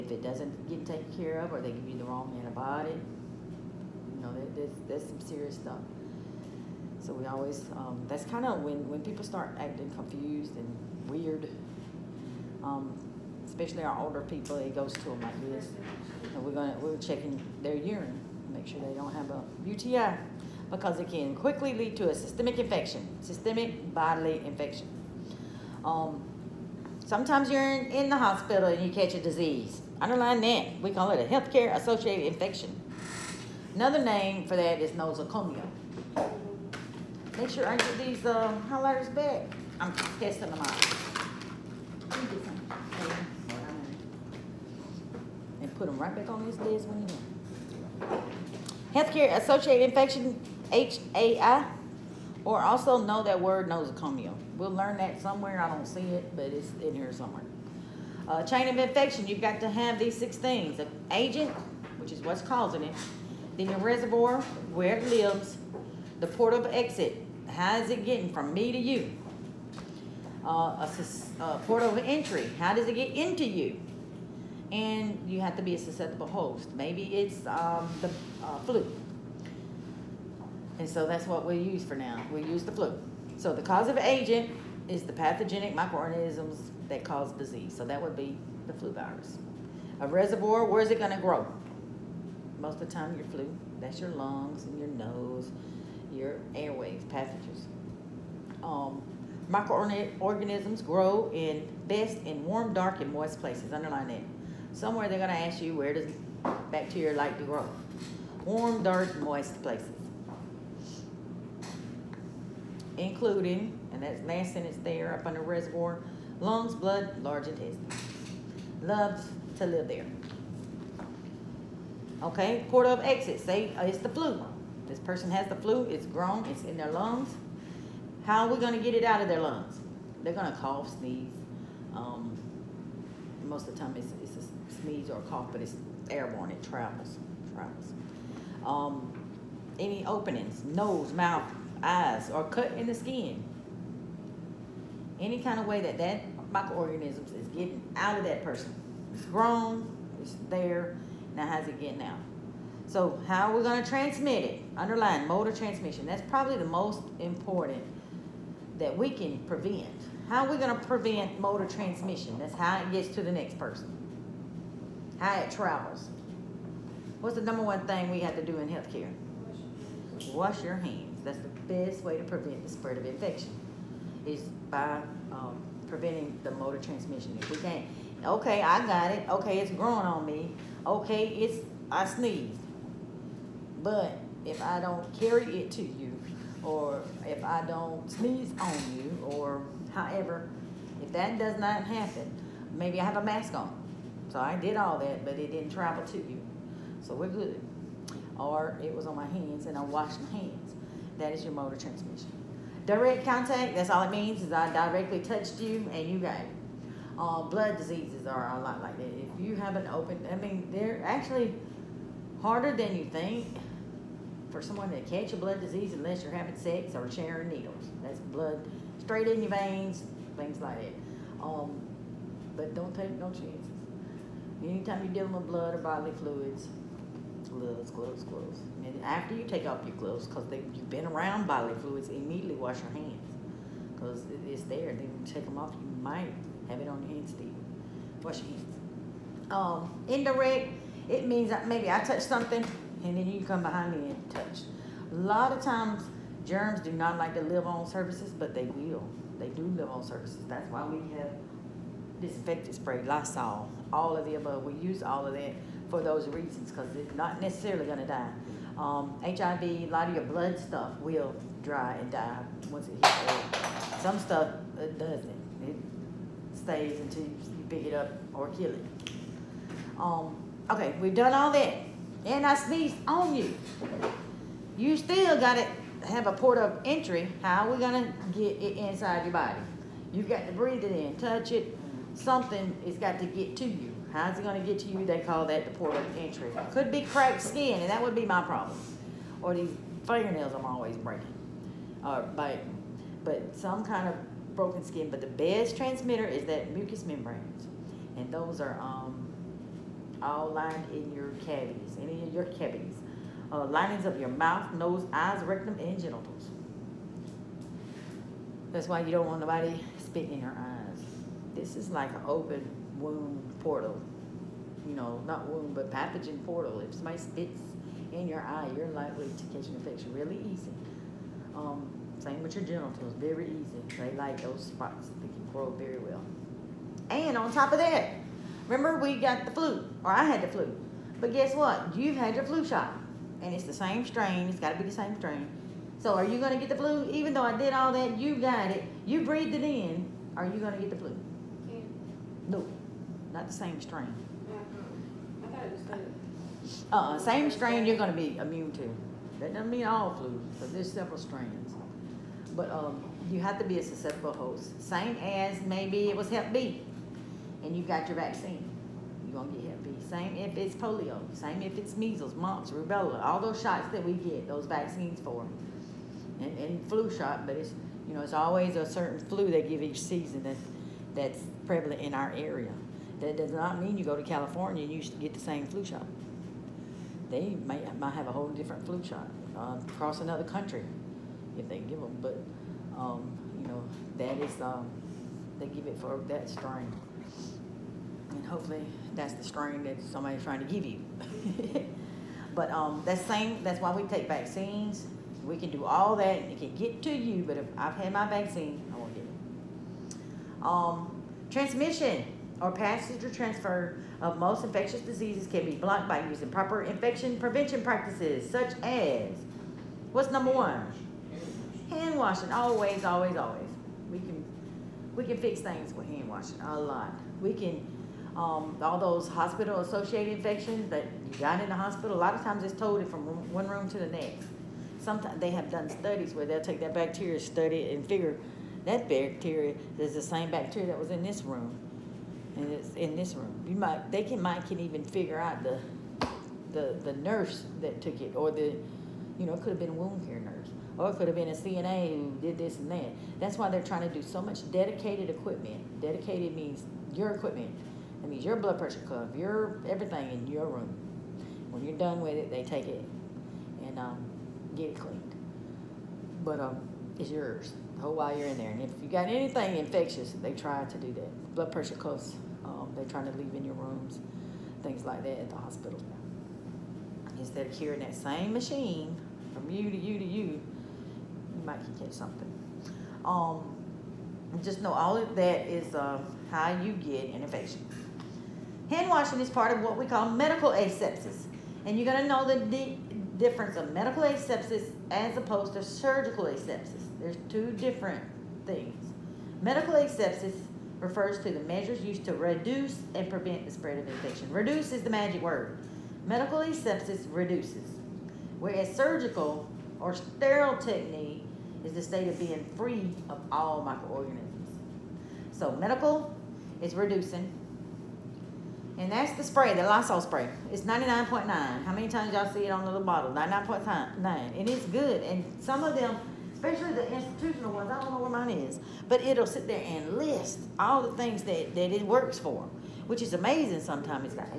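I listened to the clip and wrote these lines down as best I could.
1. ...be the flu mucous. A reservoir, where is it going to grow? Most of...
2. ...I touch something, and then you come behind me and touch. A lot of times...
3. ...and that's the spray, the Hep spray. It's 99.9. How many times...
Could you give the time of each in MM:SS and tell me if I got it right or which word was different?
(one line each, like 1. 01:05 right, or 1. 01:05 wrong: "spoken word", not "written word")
1. 01:28 wrong: "virus", not "mucous"
2. 04:01 right
3. 08:28 wrong: "Lysol", not "Hep".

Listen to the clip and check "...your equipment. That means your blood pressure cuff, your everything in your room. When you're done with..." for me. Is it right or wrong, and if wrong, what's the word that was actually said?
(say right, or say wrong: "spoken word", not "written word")
right.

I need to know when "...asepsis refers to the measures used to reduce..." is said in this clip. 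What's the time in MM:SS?
08:09.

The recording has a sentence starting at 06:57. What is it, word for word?
We can um, all those hospital associated infections that you got in the hospital.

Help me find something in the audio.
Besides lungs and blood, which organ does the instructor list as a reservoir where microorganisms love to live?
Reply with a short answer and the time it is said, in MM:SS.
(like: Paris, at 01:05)
large intestine, at 01:57.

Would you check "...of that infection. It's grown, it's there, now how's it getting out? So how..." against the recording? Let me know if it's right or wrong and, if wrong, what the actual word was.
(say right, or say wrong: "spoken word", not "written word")
wrong: "person", not "infection".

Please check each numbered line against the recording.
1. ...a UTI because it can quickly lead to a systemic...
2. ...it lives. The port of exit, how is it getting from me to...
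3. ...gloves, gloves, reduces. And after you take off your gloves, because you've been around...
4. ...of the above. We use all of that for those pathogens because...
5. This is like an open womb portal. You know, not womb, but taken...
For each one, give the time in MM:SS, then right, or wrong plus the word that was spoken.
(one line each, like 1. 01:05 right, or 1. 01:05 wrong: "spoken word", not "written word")
1. 00:19 right
2. 01:04 right
3. 03:47 wrong: "gloves", not "reduces"
4. 04:14 wrong: "reasons", not "pathogens"
5. 05:11 wrong: "pathogen", not "taken".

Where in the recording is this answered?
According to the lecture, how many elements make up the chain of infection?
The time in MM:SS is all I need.
01:00.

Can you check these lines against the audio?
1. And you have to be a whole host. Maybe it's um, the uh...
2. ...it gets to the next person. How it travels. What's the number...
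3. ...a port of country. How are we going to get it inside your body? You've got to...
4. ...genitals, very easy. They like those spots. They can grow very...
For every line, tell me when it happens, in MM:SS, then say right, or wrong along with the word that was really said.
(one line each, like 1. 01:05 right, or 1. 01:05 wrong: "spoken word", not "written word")
1. 01:14 wrong: "susceptible", not "whole"
2. 02:42 right
3. 04:36 wrong: "entry", not "country"
4. 05:22 right.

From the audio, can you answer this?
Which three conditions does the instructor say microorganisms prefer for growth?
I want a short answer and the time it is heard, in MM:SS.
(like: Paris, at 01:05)
warm, dark, moist, at 01:48.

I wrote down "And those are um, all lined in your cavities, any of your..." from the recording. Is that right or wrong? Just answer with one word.
right.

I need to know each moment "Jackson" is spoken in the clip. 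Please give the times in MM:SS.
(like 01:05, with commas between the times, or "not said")
not said.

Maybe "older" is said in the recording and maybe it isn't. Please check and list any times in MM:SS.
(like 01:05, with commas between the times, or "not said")
00:13.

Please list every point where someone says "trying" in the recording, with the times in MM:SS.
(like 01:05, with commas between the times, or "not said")
06:30, 07:23, 07:43.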